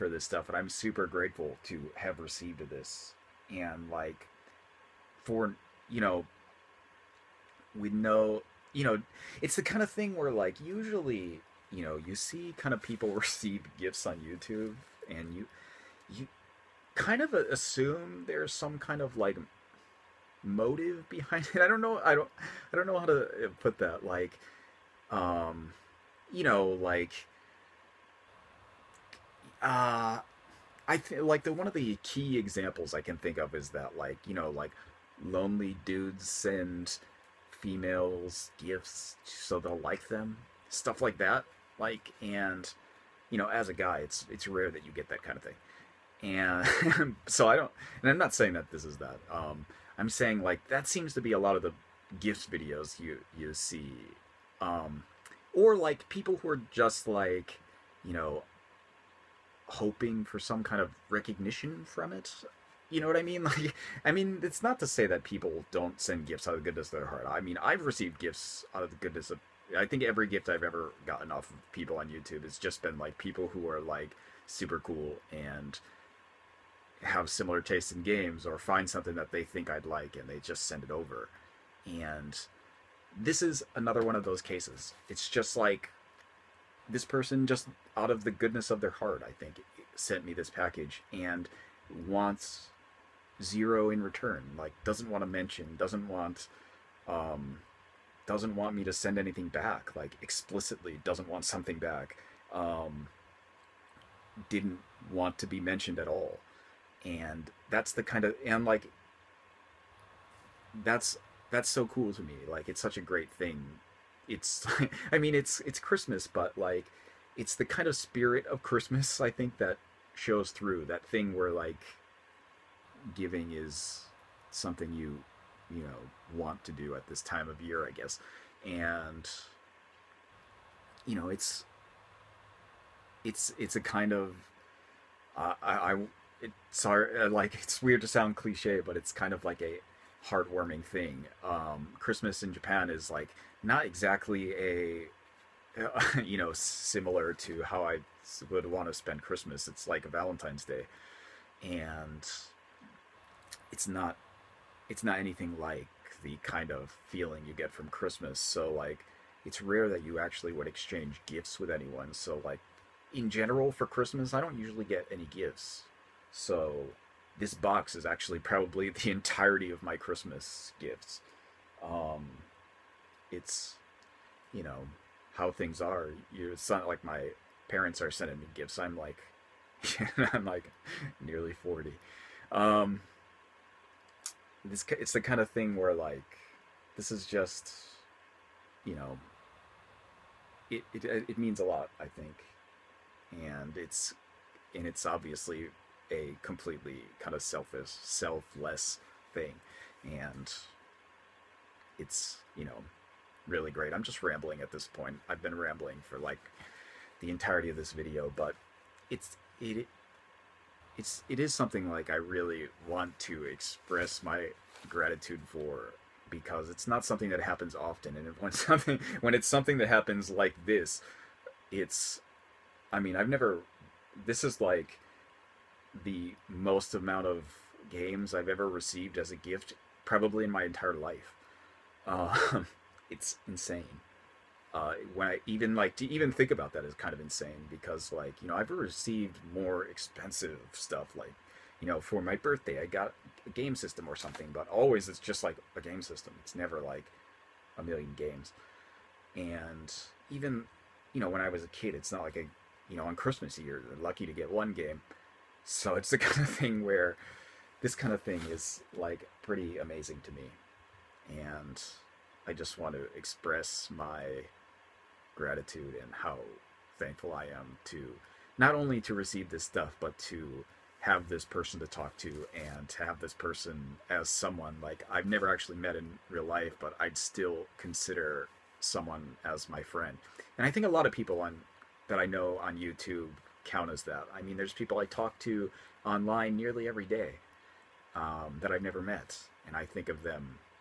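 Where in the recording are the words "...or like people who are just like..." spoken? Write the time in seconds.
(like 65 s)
55 s.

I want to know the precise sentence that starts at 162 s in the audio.
So like in general for Christmas, I don't usually get any gifts.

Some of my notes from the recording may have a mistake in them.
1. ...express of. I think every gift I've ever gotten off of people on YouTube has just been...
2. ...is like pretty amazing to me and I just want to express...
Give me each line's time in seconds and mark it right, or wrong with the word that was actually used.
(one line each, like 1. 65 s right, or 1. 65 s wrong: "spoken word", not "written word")
1. 68 s wrong: "goodness", not "express"
2. 258 s right.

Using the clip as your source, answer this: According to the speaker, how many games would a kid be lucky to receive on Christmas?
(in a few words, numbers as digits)
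1.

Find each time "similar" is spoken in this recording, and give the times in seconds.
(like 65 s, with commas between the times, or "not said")
77 s, 146 s.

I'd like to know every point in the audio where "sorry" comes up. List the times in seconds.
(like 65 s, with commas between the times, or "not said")
136 s.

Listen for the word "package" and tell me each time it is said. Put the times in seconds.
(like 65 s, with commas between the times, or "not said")
90 s.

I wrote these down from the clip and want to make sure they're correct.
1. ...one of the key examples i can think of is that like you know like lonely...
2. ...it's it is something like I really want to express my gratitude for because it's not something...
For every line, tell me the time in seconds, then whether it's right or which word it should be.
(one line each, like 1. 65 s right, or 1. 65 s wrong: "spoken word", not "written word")
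1. 31 s right
2. 210 s right.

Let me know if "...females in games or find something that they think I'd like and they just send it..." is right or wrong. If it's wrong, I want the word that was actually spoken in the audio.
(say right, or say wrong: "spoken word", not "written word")
wrong: "tastes", not "females".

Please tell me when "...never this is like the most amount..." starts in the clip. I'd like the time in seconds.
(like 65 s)
223 s.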